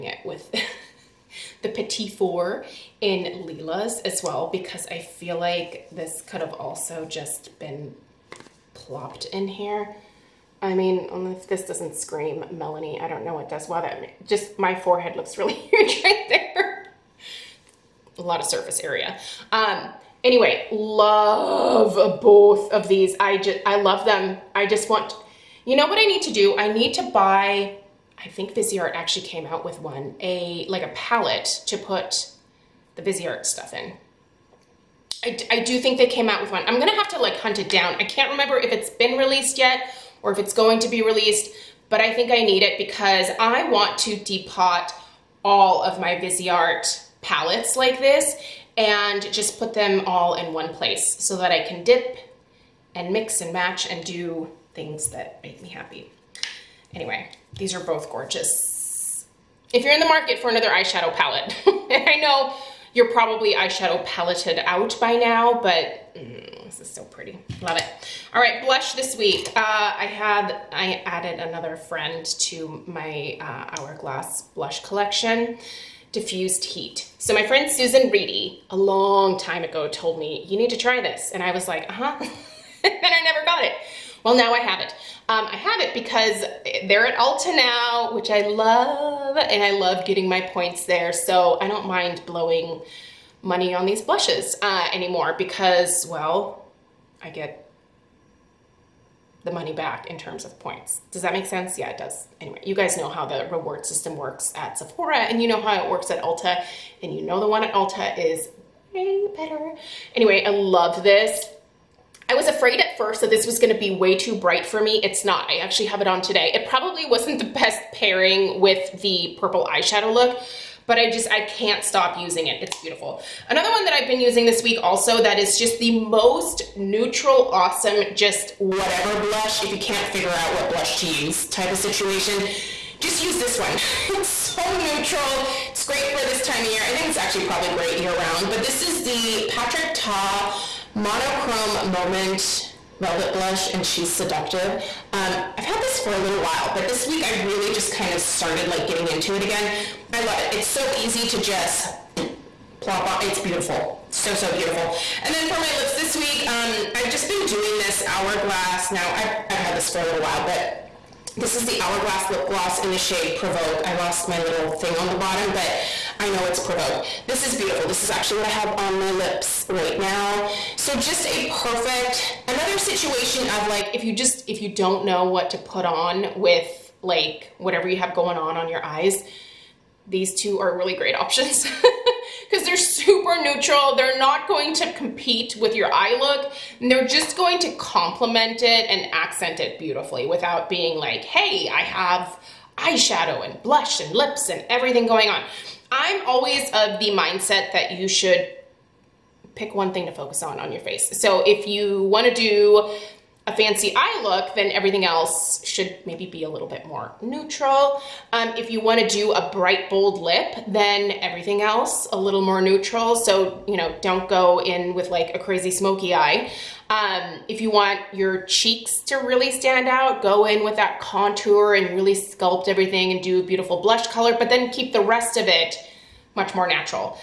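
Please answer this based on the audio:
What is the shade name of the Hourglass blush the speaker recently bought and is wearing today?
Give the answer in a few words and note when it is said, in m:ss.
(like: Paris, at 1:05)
Diffused Heat, at 1:16.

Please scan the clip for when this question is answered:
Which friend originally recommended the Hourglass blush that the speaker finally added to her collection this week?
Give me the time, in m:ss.
1:17.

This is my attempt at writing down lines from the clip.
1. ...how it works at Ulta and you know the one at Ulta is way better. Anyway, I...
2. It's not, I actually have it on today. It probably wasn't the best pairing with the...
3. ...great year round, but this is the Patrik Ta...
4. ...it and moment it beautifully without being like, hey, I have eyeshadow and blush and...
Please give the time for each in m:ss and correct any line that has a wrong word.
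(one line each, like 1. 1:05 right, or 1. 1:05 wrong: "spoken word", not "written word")
1. 1:45 right
2. 1:55 right
3. 2:17 right
4. 3:08 wrong: "accent", not "moment".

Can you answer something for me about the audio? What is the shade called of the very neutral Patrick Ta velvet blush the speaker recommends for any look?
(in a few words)
She's Seductive.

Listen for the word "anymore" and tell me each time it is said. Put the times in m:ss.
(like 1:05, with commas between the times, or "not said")
1:34.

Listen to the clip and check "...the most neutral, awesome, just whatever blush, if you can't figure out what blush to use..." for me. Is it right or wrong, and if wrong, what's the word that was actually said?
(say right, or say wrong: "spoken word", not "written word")
right.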